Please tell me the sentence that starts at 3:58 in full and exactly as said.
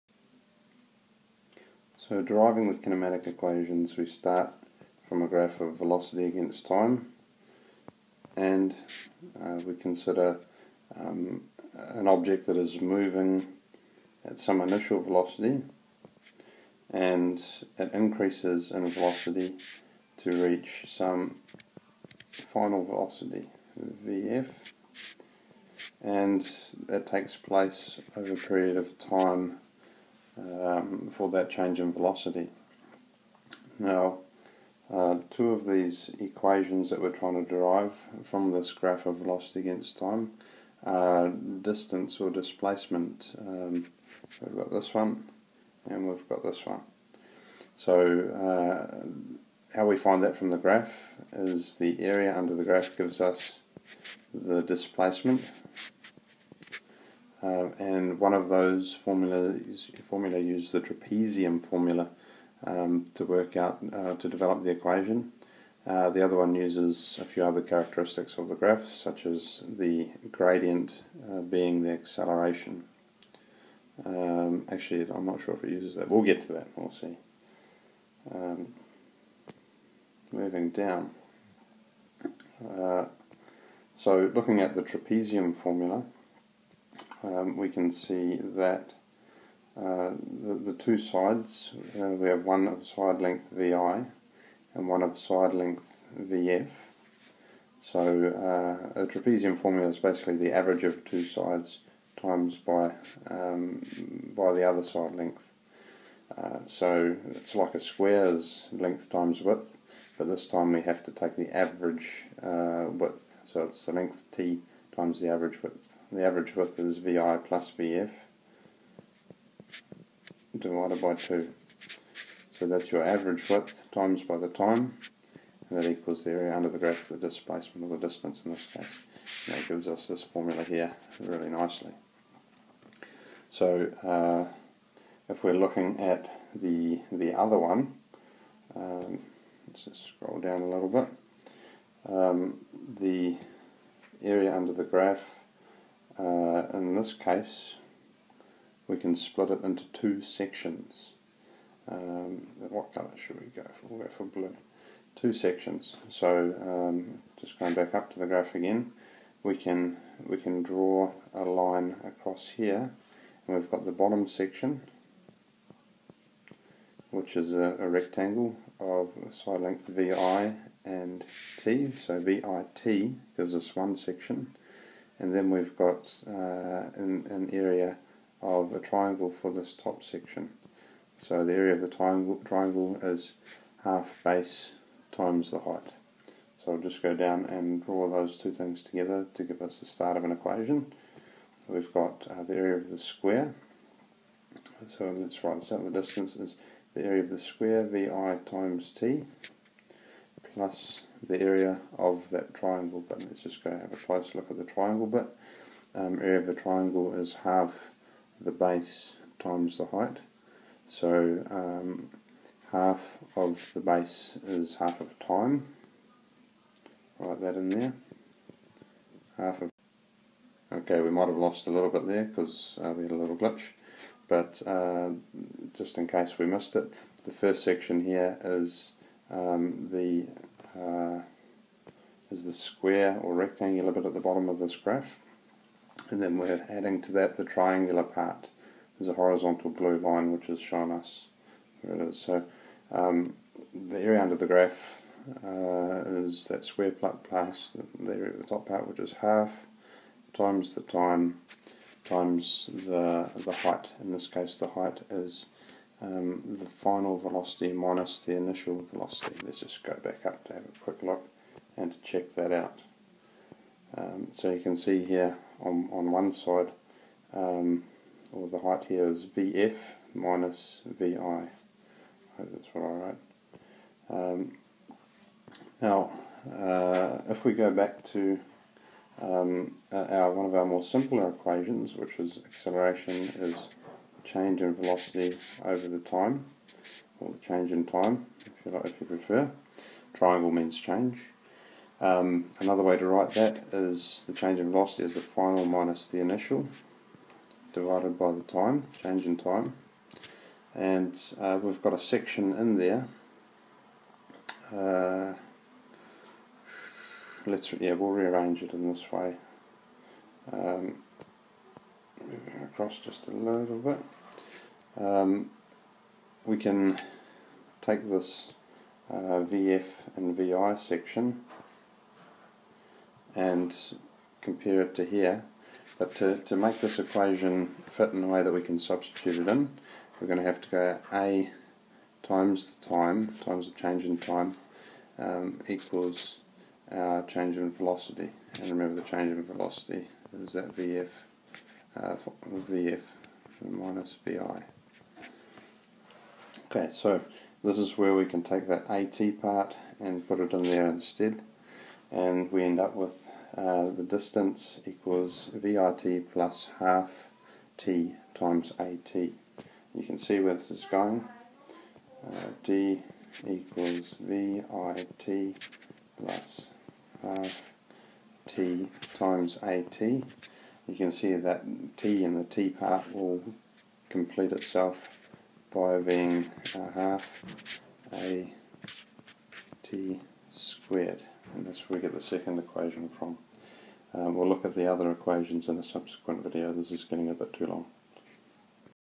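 There's a horizontal blue line which is shown us.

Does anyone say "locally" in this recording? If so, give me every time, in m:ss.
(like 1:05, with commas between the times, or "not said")
not said.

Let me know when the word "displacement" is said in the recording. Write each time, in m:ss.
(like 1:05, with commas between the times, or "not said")
0:42, 0:54, 2:07.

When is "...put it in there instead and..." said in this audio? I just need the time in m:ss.
5:50.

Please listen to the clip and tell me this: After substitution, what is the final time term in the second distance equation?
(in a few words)
Half AT squared.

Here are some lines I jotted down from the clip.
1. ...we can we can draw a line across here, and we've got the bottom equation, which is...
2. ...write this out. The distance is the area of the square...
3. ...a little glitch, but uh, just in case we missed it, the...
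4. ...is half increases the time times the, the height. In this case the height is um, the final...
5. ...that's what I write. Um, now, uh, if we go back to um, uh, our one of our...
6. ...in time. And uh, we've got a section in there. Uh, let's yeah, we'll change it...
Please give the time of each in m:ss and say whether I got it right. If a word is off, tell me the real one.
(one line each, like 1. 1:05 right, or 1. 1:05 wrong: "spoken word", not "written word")
1. 2:39 wrong: "section", not "equation"
2. 3:15 right
3. 3:43 right
4. 4:08 wrong: "times", not "increases"
5. 4:32 right
6. 4:59 wrong: "rearrange", not "change".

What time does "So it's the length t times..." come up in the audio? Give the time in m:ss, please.
1:53.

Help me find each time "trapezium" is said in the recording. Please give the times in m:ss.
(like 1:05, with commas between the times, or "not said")
1:00, 1:24, 1:39.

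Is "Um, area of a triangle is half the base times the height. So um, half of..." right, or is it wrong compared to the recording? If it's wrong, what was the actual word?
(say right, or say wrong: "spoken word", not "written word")
right.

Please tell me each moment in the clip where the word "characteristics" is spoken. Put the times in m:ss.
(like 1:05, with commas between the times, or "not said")
1:07.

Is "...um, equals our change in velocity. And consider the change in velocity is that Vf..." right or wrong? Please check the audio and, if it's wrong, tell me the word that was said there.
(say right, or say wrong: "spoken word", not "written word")
wrong: "remember", not "consider".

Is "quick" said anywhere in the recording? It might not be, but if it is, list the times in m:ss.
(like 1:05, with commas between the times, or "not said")
4:20.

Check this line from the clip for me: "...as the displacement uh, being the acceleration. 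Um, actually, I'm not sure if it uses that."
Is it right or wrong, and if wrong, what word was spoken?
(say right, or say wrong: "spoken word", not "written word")
wrong: "gradient", not "displacement".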